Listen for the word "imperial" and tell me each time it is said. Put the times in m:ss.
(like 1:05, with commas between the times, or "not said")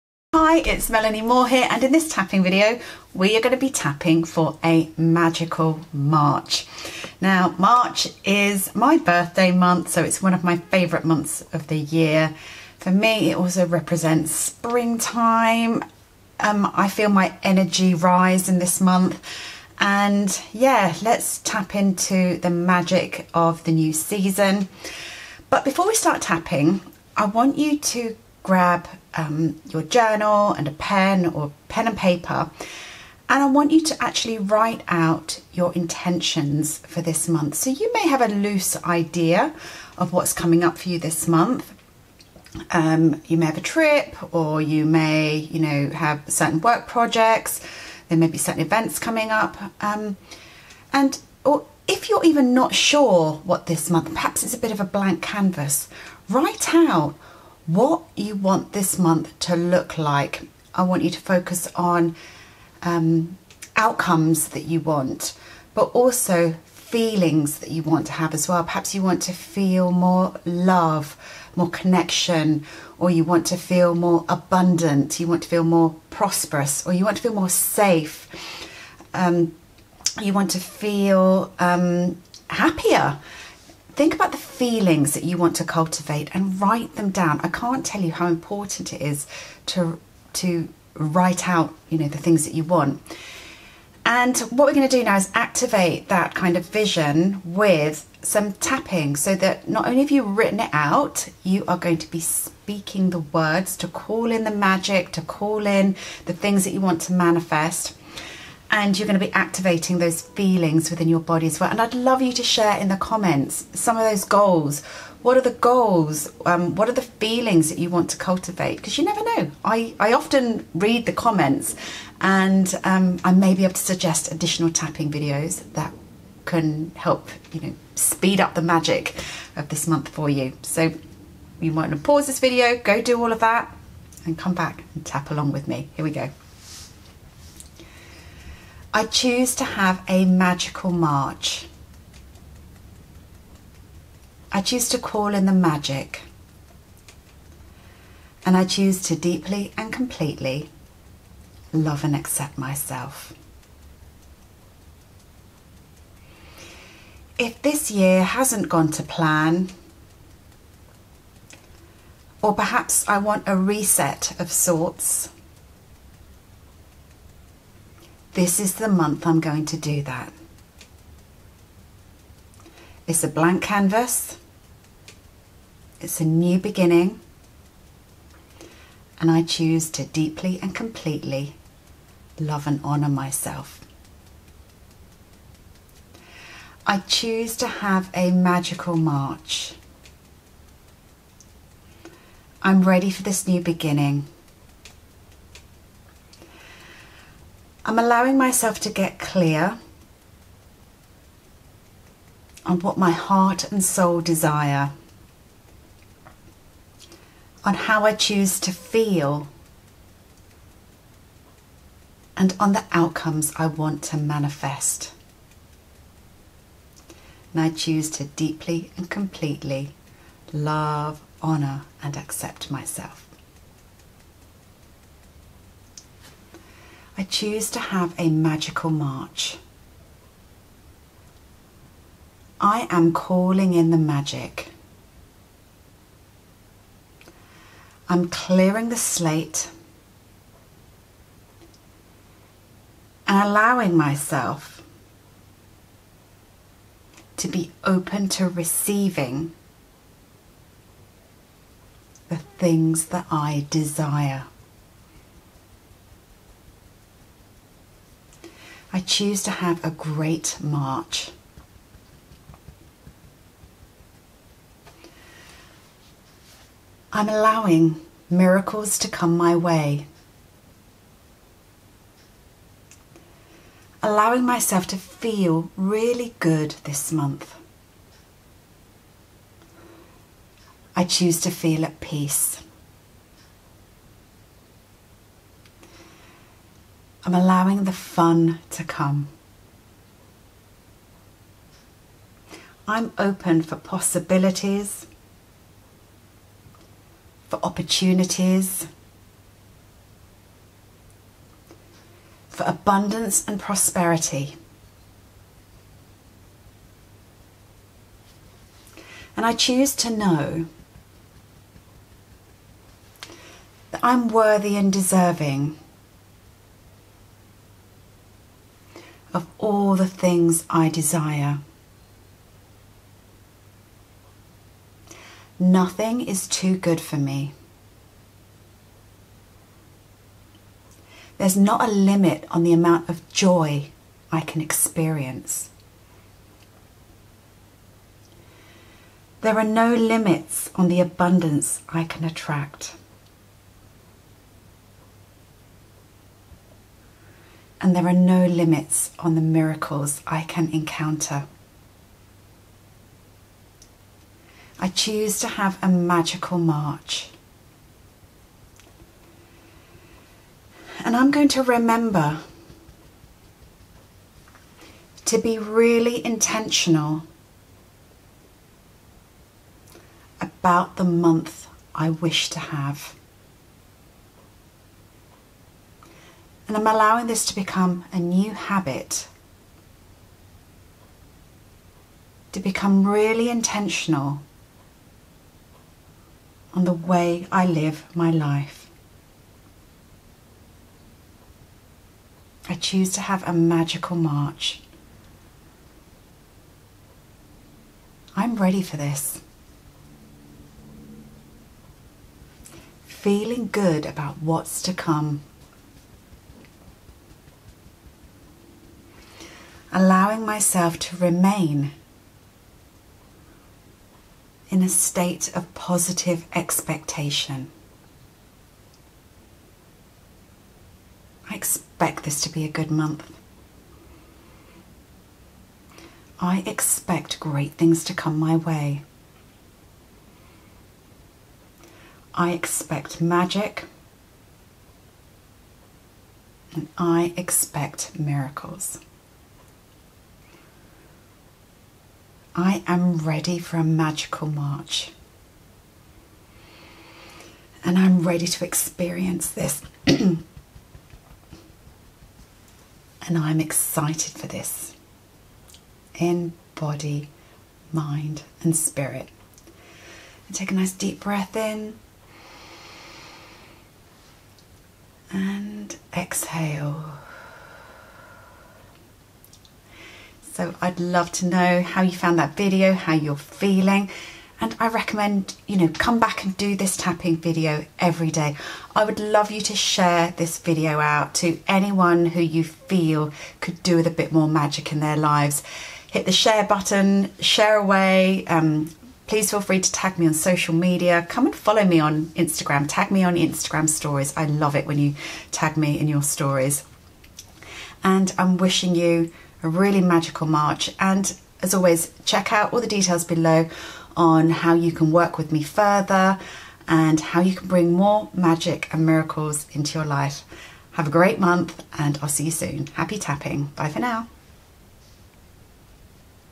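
not said.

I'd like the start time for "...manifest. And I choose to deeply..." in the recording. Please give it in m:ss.
3:34.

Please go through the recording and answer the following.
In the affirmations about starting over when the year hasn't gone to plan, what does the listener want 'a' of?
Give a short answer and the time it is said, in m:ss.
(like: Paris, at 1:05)
Reset, at 2:43.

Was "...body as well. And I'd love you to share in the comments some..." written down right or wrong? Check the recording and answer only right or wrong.
right.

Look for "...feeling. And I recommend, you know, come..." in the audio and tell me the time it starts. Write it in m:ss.
7:53.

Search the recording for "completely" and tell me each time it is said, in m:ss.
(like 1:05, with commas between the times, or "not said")
2:29, 3:00, 3:39.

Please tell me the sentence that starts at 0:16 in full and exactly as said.
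Um, I feel my energy rise in this month and yeah let's tap into the magic of the new season.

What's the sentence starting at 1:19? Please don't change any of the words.
Um, you want to feel um, happier think about the feelings that you want to cultivate and write them down.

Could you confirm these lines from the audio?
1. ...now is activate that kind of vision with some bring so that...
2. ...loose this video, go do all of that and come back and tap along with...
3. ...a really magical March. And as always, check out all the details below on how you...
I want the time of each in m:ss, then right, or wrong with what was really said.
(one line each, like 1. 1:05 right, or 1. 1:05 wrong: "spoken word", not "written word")
1. 1:35 wrong: "tapping", not "bring"
2. 2:12 wrong: "pause", not "loose"
3. 8:19 right.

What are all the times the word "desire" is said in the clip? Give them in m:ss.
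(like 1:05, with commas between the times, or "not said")
3:24, 4:13, 5:20.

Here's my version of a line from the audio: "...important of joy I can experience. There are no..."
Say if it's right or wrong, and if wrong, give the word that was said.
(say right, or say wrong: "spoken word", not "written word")
wrong: "amount", not "important".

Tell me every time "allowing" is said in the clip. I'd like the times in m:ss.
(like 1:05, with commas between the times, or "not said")
3:17, 4:03, 4:27, 4:34, 4:47, 6:16, 6:49.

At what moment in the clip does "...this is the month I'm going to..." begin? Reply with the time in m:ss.
2:48.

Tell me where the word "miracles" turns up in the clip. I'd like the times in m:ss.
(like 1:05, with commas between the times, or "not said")
4:28, 5:49, 7:18, 8:29.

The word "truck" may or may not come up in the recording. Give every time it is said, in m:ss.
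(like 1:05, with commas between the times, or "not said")
not said.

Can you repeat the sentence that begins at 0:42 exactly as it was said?
Um, you may have a trip or you may, you know, have certain work projects.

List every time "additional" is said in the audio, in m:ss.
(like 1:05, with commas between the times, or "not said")
2:04.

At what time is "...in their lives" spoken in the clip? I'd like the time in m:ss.
8:04.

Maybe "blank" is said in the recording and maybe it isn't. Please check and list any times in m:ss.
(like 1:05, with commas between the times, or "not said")
0:54, 2:53.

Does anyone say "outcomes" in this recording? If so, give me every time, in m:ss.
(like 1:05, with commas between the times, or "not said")
1:03, 3:32.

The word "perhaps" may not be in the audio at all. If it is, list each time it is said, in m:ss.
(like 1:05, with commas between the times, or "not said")
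0:54, 1:08, 2:42.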